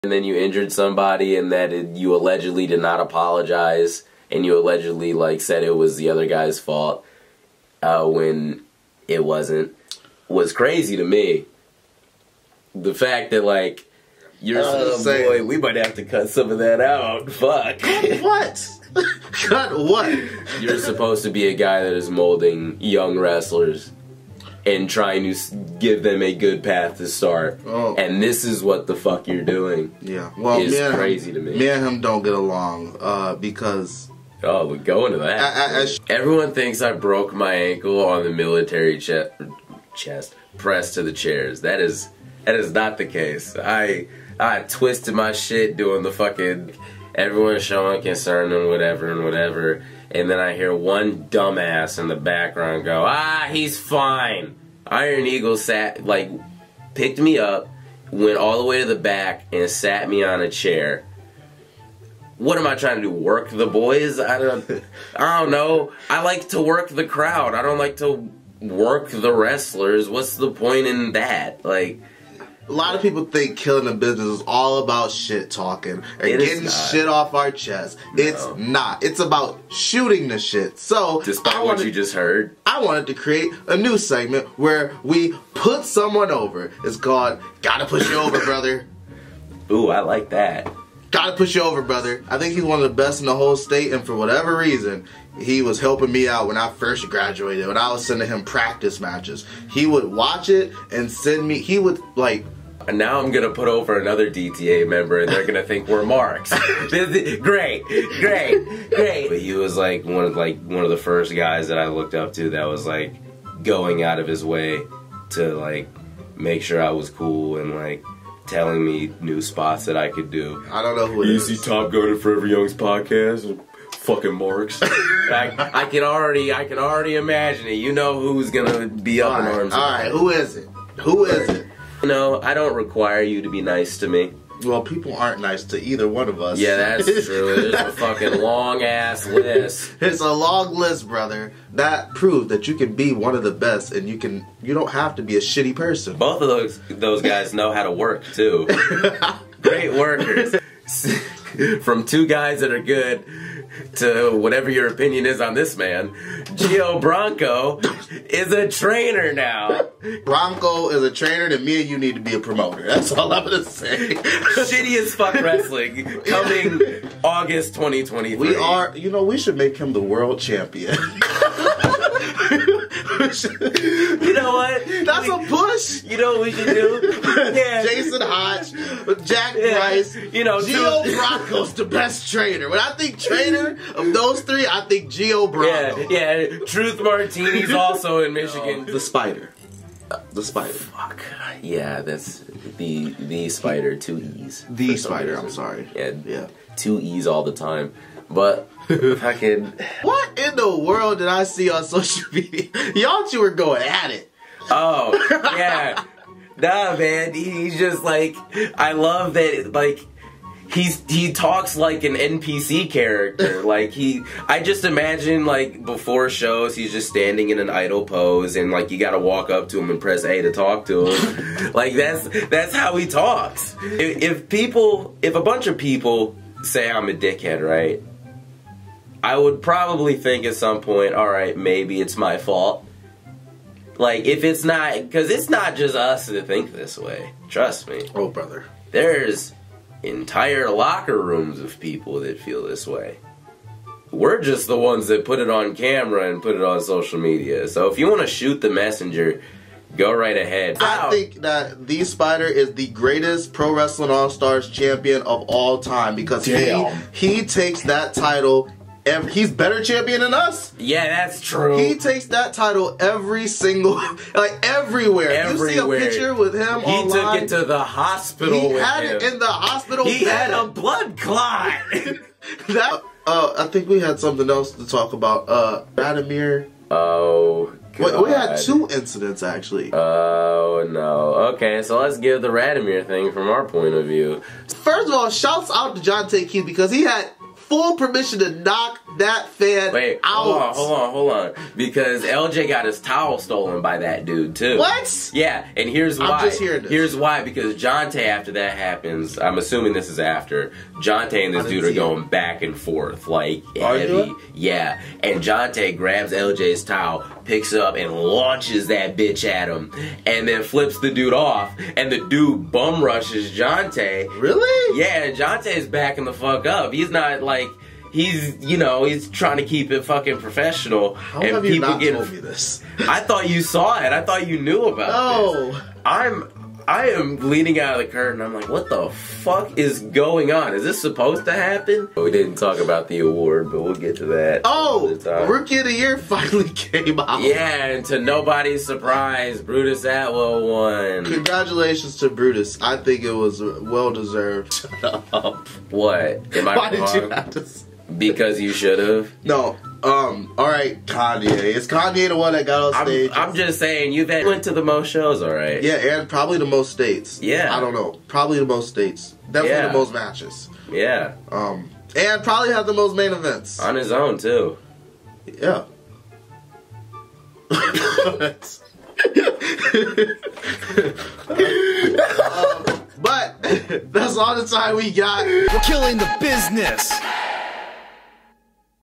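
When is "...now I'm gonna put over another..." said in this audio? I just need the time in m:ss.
1:42.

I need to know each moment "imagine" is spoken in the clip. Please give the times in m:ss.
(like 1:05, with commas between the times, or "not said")
2:07, 3:34.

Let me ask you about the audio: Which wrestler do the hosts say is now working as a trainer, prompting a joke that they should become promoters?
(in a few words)
Gio Bronco.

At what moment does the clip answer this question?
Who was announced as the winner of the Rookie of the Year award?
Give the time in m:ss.
5:39.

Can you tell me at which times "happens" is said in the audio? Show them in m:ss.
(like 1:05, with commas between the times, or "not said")
4:58, 5:31.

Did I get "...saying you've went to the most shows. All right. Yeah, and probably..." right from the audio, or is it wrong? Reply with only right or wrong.
right.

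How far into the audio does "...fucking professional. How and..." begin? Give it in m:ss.
5:20.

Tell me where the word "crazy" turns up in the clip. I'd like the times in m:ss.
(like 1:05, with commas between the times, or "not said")
0:10, 0:30.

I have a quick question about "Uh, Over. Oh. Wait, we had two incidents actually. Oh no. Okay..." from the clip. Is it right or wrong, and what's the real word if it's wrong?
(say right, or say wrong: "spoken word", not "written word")
wrong: "Vladimir", not "Over".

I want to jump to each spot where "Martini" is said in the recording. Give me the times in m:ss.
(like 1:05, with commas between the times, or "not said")
3:07.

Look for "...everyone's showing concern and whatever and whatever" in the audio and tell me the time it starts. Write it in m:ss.
0:47.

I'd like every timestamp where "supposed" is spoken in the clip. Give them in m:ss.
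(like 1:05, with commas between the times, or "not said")
0:20, 5:30.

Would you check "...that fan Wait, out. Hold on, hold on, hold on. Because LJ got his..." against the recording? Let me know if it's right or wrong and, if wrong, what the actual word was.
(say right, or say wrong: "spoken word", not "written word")
right.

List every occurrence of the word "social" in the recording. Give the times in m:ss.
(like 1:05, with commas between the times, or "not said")
3:21, 4:06.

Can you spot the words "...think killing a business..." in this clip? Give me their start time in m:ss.
1:13.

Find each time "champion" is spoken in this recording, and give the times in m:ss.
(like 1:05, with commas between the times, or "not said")
2:50, 4:14, 4:19.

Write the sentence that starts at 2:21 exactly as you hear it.
That proved that you can be one of the best, and you can you don't have to be a shitty person.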